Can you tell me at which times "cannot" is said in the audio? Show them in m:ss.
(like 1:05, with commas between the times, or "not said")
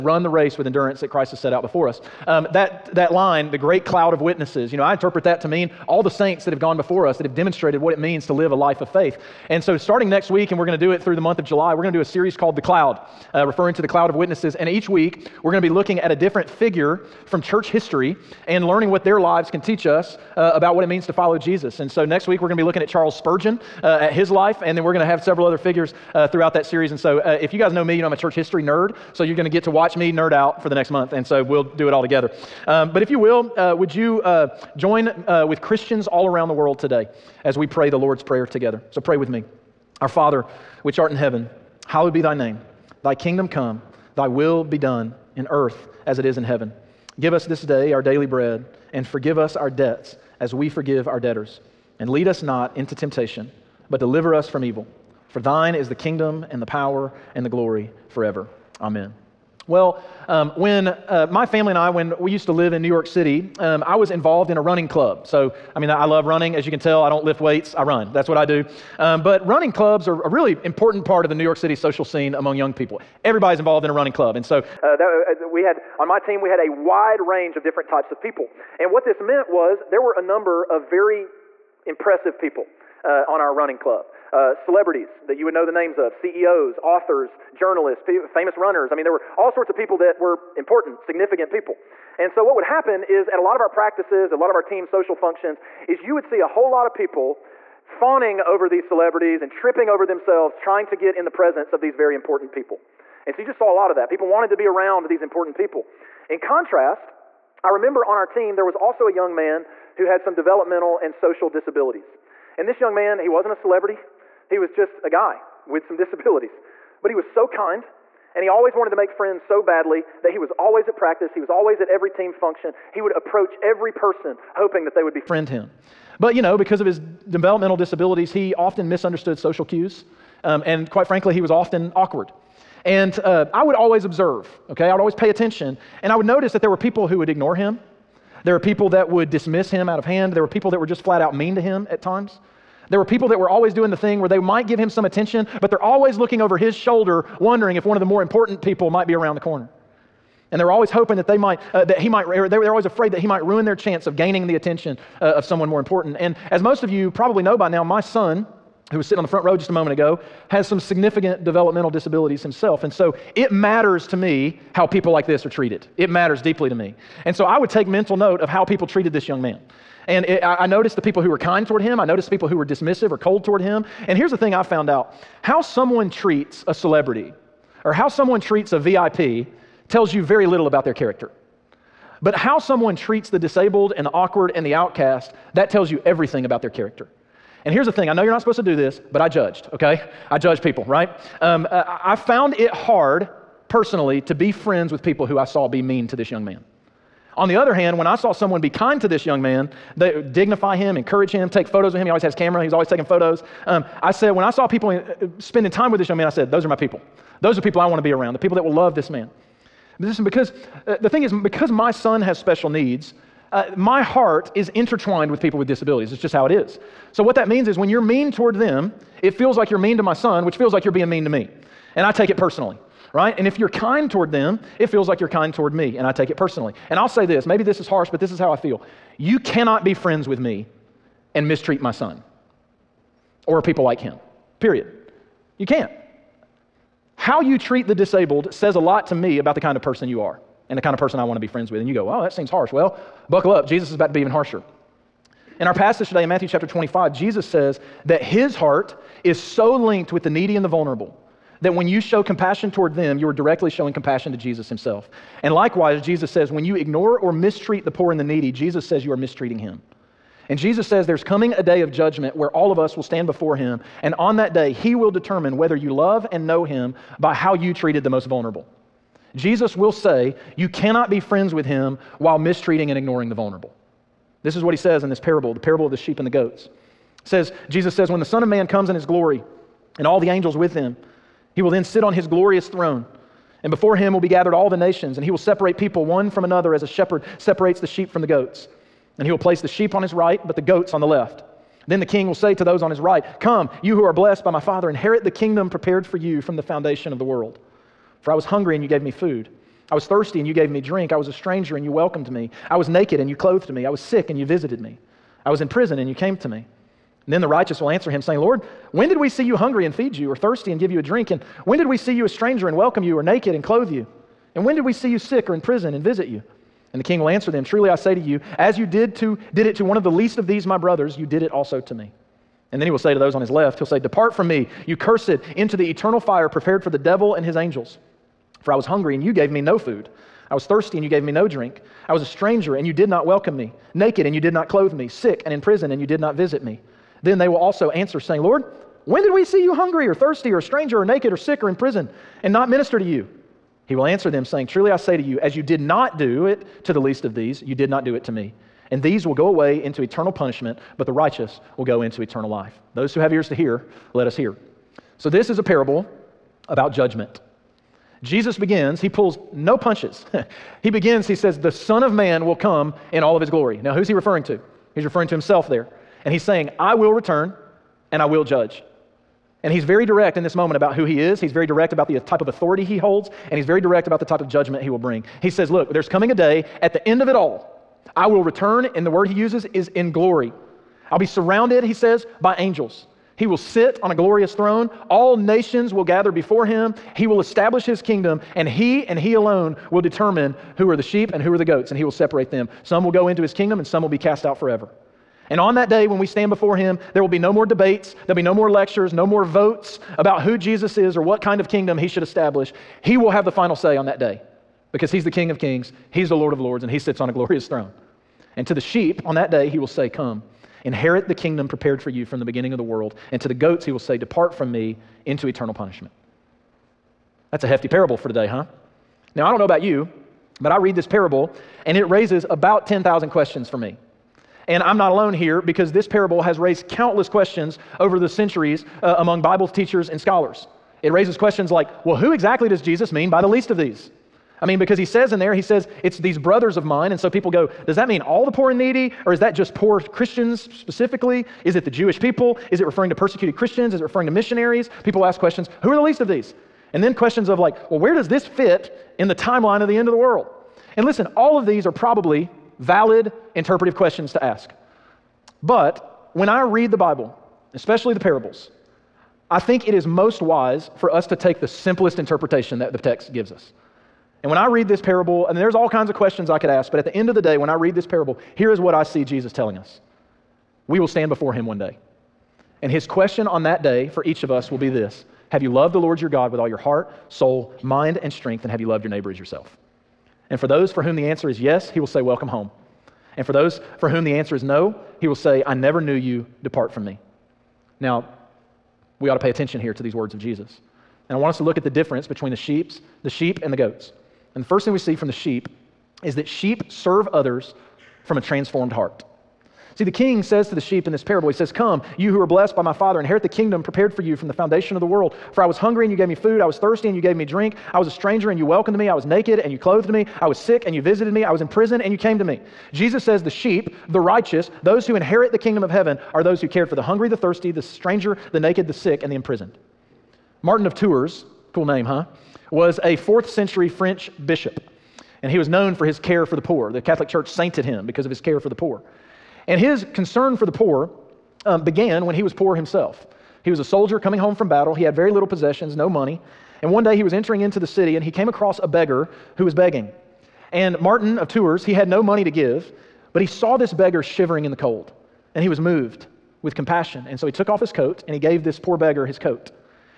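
3:49, 4:30.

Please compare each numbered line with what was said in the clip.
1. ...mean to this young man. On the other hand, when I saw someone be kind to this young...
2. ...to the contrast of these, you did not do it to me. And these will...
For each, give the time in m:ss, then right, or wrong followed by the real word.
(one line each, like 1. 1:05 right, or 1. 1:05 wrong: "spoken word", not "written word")
1. 3:15 right
2. 5:46 wrong: "least", not "contrast".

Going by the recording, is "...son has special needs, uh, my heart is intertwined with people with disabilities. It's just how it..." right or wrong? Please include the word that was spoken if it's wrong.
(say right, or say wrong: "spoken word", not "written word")
right.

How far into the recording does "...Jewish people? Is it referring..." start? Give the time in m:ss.
7:21.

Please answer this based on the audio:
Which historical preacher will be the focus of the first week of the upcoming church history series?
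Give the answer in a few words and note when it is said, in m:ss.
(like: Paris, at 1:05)
Charles Spurgeon, at 0:22.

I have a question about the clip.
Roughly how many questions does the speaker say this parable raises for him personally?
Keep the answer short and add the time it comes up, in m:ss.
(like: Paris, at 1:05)
10,000, at 7:02.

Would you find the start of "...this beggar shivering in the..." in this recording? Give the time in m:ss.
9:03.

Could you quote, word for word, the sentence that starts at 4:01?
And you go, oh, that seems harsh.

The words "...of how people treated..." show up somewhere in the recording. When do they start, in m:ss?
2:48.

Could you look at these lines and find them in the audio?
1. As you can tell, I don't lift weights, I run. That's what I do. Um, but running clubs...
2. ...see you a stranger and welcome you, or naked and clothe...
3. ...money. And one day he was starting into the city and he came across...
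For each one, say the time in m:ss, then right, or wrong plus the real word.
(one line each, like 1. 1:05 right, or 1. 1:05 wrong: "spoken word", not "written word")
1. 1:06 right
2. 5:11 right
3. 8:56 wrong: "entering", not "starting".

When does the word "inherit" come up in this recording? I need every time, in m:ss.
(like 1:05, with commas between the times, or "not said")
4:54, 6:50, 8:23, 8:35.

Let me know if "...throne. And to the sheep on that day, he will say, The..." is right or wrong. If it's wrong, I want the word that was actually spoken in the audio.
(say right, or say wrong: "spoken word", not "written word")
wrong: "Come", not "The".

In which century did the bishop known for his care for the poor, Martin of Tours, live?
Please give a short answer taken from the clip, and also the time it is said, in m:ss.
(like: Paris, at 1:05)
Fourth century, at 8:43.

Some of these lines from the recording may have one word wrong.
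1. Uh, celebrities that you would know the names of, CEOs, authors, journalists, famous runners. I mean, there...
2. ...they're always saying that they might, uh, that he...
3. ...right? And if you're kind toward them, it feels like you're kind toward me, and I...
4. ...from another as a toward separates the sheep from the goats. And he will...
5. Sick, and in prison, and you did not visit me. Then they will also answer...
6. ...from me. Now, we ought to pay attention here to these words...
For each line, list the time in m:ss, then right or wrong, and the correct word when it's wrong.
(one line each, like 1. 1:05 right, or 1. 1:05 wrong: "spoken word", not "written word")
1. 1:24 right
2. 2:30 wrong: "hoping", not "saying"
3. 3:43 right
4. 4:46 wrong: "shepherd", not "toward"
5. 5:35 right
6. 8:06 right.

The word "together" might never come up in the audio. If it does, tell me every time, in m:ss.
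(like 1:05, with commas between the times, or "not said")
0:32, 0:38.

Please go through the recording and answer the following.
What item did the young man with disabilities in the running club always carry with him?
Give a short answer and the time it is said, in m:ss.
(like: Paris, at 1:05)
His camera, at 3:22.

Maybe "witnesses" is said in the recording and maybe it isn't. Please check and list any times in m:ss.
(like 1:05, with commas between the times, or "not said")
0:04, 0:14.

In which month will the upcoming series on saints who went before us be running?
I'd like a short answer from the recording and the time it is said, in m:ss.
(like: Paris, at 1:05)
July, at 0:11.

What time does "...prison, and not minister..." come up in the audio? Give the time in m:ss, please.
5:41.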